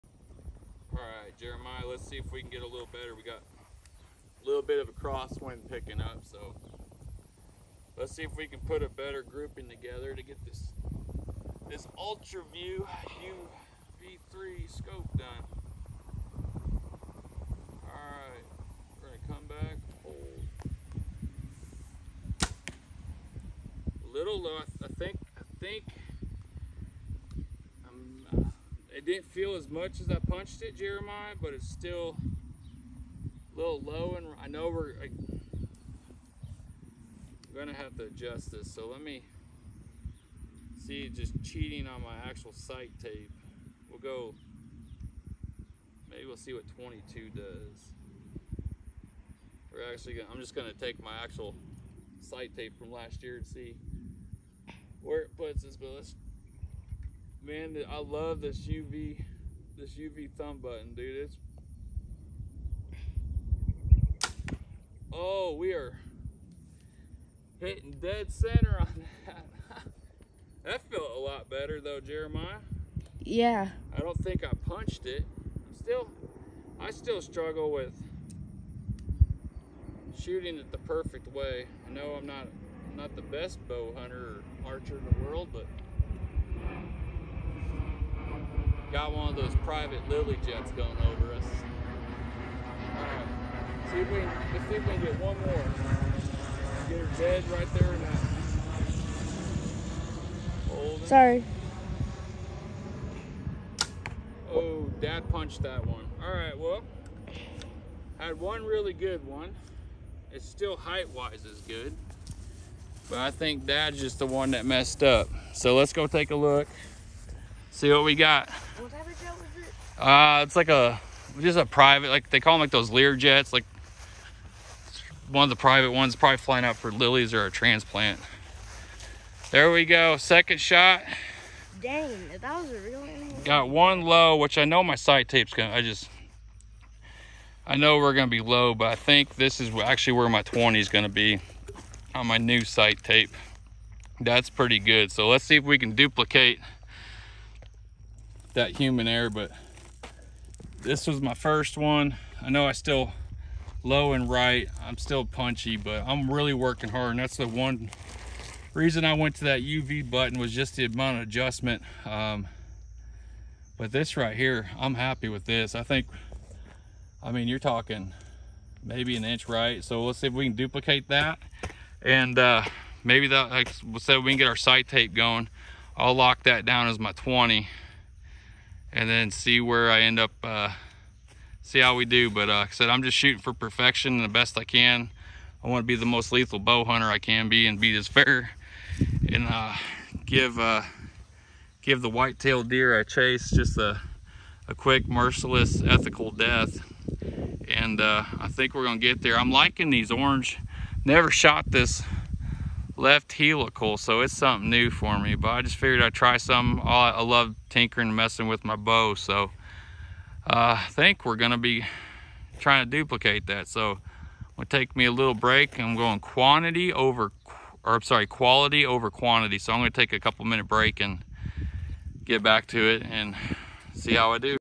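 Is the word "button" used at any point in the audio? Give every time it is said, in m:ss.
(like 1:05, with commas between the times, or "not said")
1:00, 2:40.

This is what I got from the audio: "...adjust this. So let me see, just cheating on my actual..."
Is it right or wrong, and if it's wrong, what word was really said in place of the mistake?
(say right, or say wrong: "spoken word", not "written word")
right.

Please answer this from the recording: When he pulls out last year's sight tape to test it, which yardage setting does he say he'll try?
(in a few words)
22.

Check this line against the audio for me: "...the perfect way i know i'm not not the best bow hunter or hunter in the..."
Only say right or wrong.
wrong.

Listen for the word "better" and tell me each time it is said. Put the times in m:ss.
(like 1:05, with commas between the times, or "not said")
0:02, 0:08, 1:11.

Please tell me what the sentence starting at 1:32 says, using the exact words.
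Alright, see if we let's see if we can get one more.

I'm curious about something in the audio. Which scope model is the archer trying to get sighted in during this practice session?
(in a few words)
UltraView UV3.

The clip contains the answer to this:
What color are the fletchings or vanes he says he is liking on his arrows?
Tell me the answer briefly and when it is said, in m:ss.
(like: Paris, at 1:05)
Orange, at 3:20.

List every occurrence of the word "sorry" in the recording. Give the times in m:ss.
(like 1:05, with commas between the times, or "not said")
1:41, 3:38.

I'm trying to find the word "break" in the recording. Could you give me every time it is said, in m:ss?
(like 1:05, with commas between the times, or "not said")
3:35, 3:40.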